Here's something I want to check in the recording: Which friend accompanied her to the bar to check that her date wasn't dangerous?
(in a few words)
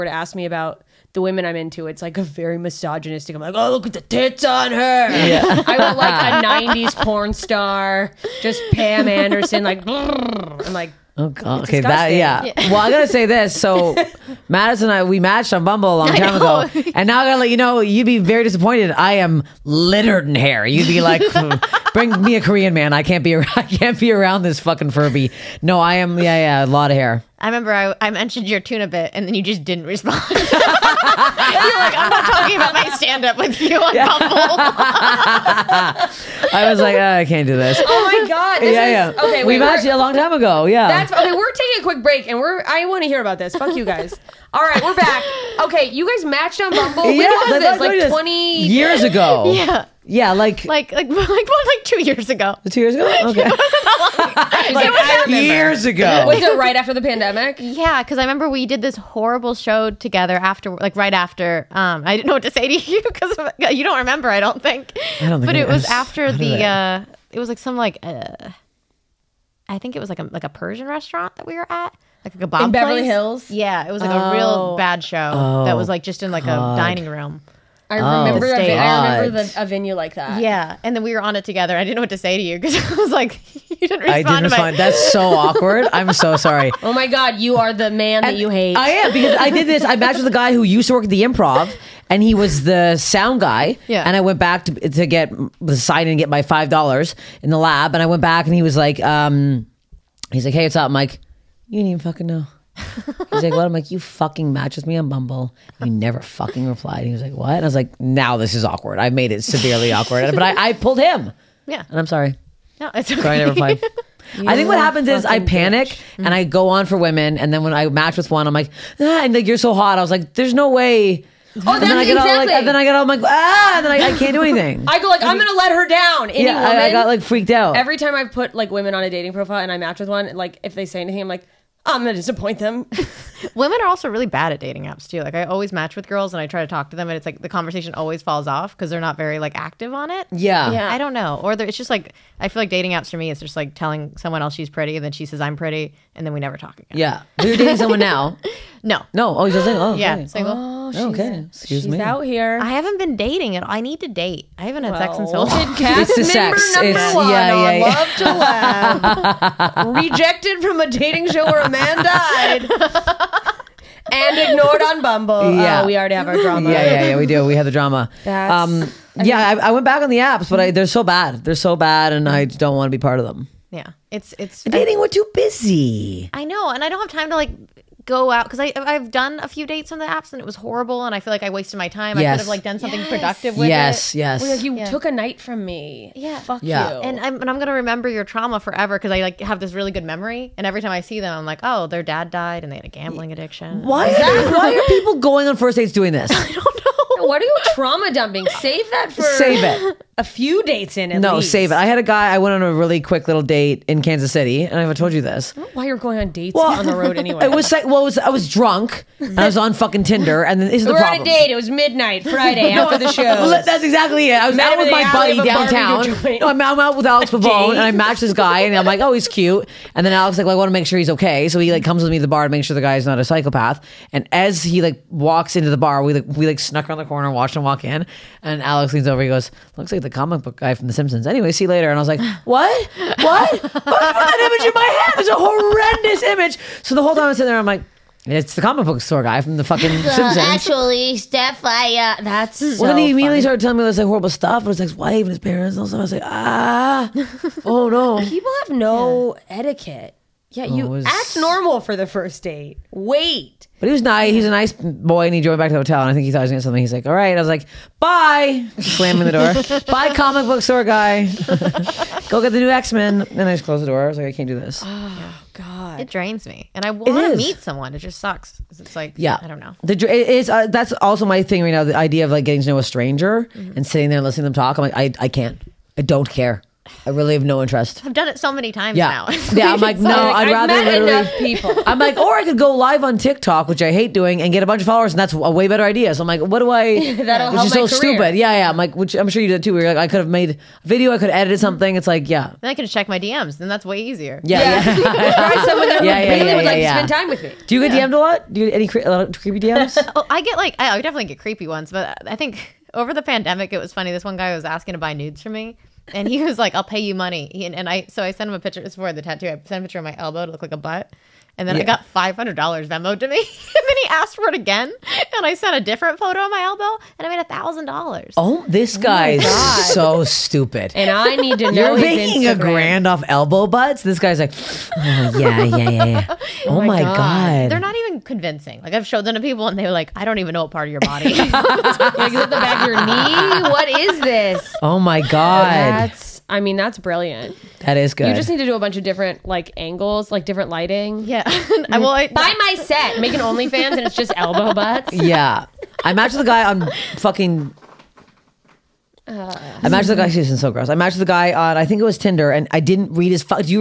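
Alex Pavone.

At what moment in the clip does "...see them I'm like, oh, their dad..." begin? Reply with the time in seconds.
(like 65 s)
191 s.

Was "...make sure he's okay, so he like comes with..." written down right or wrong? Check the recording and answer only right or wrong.
right.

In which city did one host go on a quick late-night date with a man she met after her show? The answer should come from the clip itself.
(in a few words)
Kansas City.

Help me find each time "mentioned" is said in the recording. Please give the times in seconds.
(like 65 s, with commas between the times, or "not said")
28 s.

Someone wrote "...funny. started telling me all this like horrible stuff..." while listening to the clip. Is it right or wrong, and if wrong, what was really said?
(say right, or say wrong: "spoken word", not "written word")
right.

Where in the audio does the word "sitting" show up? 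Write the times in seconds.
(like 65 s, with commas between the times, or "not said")
237 s, 273 s.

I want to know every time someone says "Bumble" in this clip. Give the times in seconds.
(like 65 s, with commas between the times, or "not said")
15 s, 46 s, 105 s, 165 s.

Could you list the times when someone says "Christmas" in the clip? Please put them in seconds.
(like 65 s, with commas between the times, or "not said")
not said.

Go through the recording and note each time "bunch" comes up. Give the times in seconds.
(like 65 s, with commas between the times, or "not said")
284 s, 338 s.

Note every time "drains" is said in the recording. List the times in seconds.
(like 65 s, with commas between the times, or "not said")
266 s.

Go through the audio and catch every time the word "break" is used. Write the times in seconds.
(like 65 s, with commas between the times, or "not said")
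42 s.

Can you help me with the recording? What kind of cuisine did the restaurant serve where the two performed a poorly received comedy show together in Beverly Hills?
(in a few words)
Persian.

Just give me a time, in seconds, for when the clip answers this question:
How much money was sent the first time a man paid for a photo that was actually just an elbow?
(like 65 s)
312 s.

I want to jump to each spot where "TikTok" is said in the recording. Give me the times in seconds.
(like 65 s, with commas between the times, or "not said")
283 s.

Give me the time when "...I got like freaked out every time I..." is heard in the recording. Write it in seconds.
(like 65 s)
126 s.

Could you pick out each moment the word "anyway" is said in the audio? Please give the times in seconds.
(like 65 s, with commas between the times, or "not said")
207 s, 231 s.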